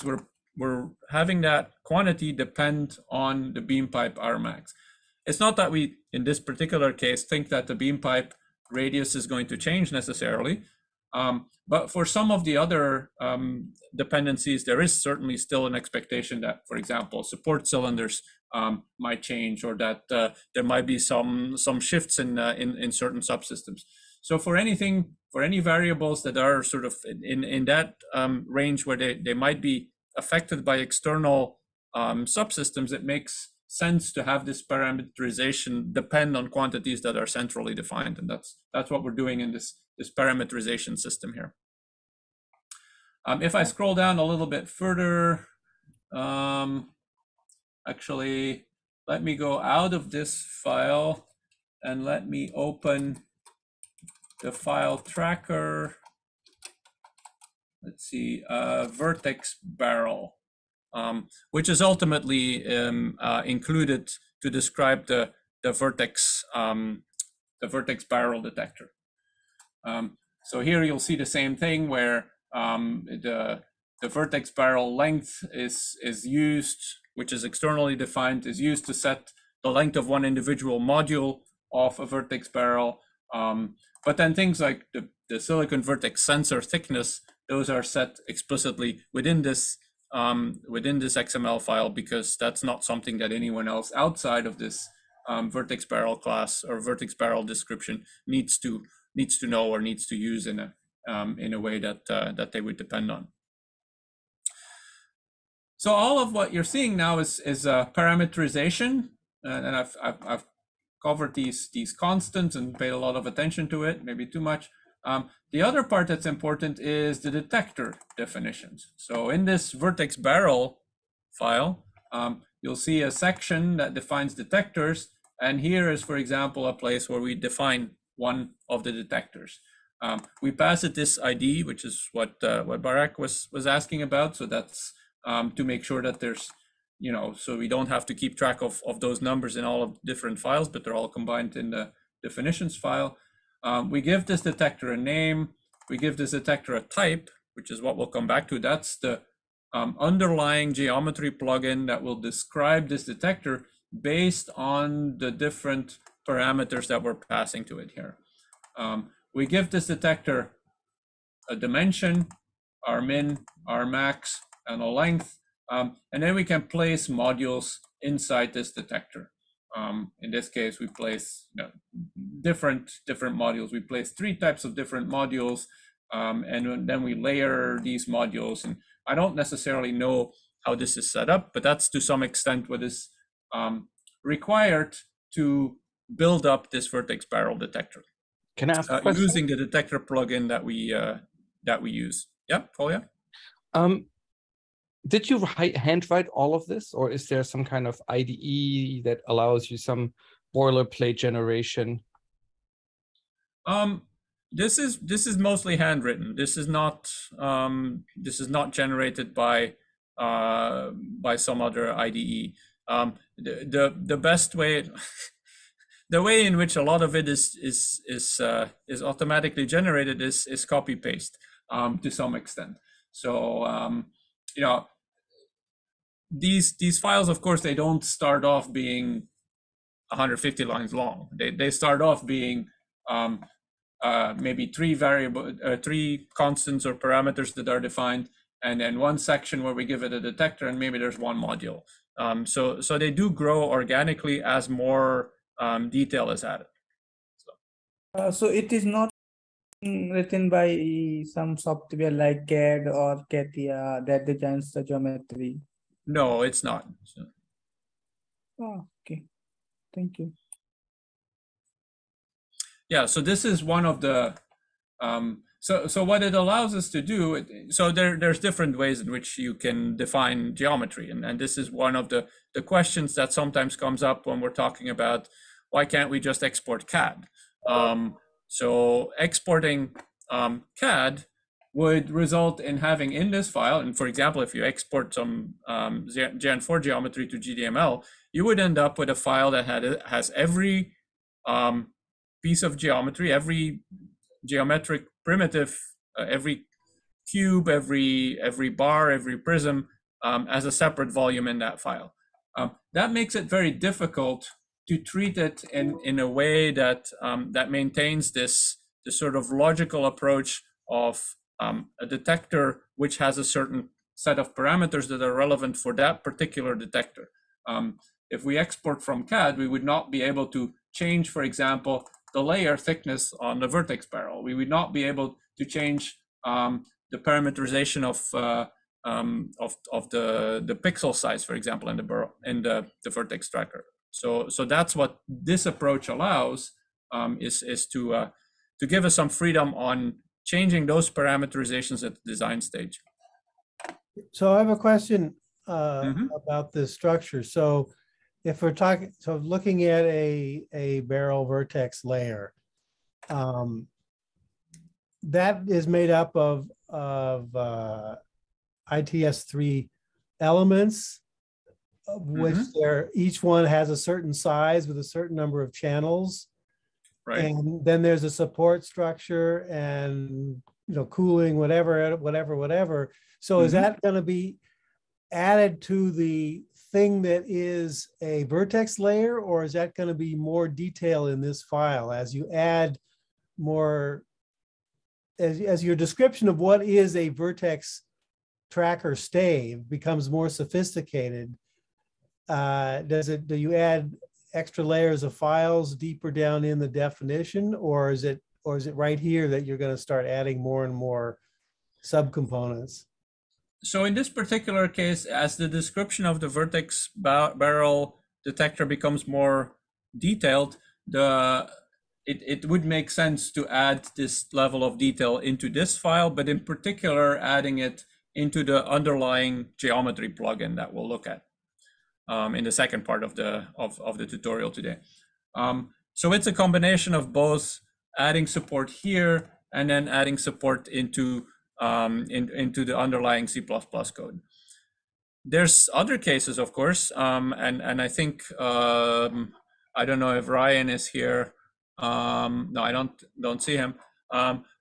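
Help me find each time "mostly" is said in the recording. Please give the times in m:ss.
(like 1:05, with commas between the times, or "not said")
3:25.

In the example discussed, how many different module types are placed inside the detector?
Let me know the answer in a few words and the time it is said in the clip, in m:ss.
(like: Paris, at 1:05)
3, at 2:54.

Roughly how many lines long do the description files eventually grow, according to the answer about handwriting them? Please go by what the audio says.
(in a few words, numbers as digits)
150.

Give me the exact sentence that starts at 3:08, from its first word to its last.
Can I ask uh, using the detector plugin that we uh, that we use?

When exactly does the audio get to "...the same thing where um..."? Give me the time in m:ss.
1:11.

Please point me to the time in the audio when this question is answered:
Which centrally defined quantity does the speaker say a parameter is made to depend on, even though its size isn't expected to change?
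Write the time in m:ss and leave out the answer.
0:03.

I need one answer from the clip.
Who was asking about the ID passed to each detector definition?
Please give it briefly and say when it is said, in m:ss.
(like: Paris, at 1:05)
Barak, at 2:12.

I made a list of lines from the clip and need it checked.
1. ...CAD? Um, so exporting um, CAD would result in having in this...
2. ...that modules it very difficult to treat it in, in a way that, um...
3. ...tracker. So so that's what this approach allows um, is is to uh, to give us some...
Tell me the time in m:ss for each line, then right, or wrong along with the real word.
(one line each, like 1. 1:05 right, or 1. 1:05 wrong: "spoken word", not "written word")
1. 4:36 right
2. 5:02 wrong: "makes", not "modules"
3. 5:33 right.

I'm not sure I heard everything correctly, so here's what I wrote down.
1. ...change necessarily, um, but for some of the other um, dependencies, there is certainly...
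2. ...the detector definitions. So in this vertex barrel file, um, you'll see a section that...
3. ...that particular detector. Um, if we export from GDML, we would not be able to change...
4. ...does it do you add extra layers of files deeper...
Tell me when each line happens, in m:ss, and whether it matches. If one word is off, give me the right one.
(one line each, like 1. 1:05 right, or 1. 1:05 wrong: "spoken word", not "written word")
1. 0:09 right
2. 1:57 right
3. 5:15 wrong: "CAD", not "GDML"
4. 6:33 right.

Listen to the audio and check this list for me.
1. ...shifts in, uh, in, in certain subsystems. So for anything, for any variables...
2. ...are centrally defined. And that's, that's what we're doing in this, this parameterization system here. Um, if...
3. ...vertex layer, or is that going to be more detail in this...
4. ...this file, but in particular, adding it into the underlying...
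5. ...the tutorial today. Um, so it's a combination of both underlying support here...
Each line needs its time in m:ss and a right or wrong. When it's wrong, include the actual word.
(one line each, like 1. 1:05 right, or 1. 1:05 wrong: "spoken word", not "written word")
1. 0:21 right
2. 0:37 right
3. 6:18 right
4. 6:55 right
5. 7:04 wrong: "adding", not "underlying".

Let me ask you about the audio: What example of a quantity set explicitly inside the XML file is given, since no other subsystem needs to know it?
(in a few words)
silicon vertex sensor thickness.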